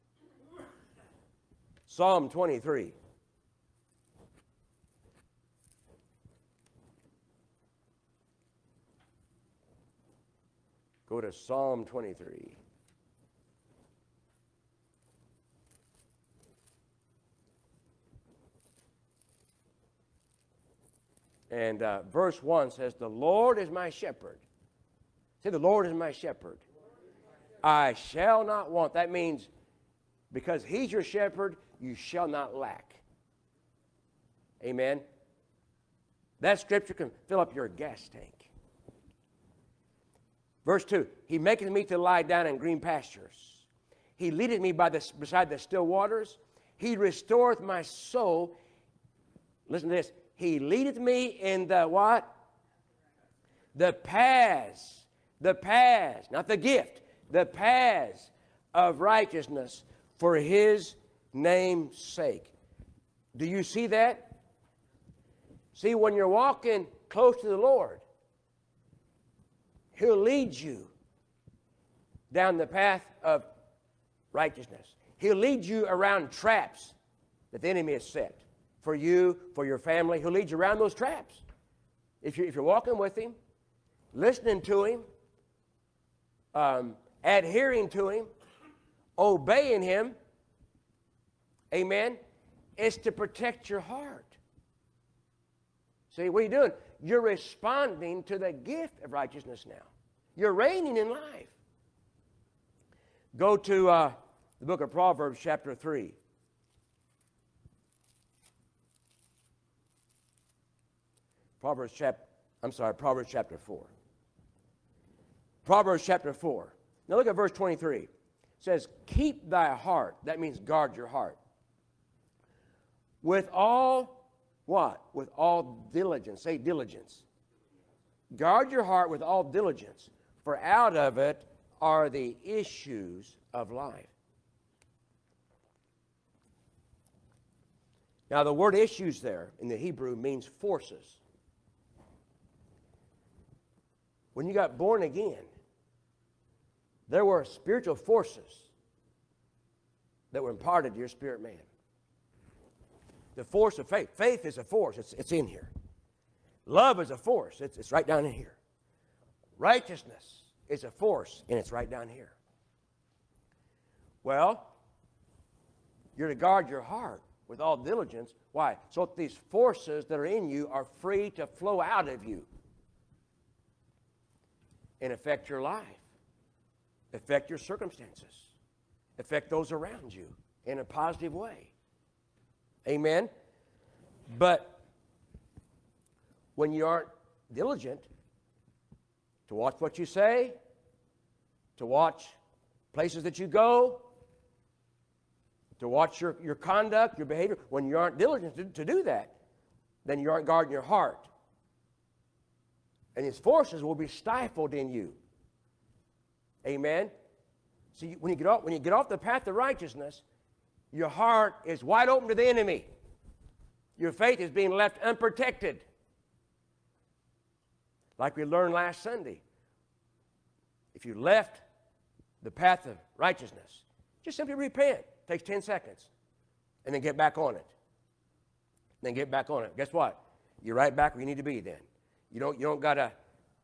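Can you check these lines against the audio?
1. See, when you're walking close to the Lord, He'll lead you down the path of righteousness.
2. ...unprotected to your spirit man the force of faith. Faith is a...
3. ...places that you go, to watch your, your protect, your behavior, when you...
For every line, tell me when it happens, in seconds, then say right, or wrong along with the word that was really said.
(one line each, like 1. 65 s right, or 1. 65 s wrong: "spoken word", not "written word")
1. 65 s right
2. 150 s wrong: "imparted", not "unprotected"
3. 192 s wrong: "conduct", not "protect".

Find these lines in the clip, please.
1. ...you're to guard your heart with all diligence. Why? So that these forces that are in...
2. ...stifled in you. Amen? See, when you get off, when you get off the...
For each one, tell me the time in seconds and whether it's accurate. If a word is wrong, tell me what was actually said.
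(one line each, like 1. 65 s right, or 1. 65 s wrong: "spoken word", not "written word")
1. 166 s right
2. 204 s right.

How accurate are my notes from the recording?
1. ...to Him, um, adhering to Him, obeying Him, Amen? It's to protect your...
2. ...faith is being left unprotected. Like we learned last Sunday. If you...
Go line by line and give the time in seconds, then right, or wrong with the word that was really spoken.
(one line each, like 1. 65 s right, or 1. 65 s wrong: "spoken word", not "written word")
1. 84 s right
2. 214 s right.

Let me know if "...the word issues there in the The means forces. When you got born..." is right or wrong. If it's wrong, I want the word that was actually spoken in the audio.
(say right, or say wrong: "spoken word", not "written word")
wrong: "Hebrew", not "The".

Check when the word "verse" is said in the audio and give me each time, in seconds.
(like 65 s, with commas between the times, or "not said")
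22 s, 40 s, 117 s.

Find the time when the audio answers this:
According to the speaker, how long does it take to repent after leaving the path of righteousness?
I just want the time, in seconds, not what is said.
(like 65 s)
225 s.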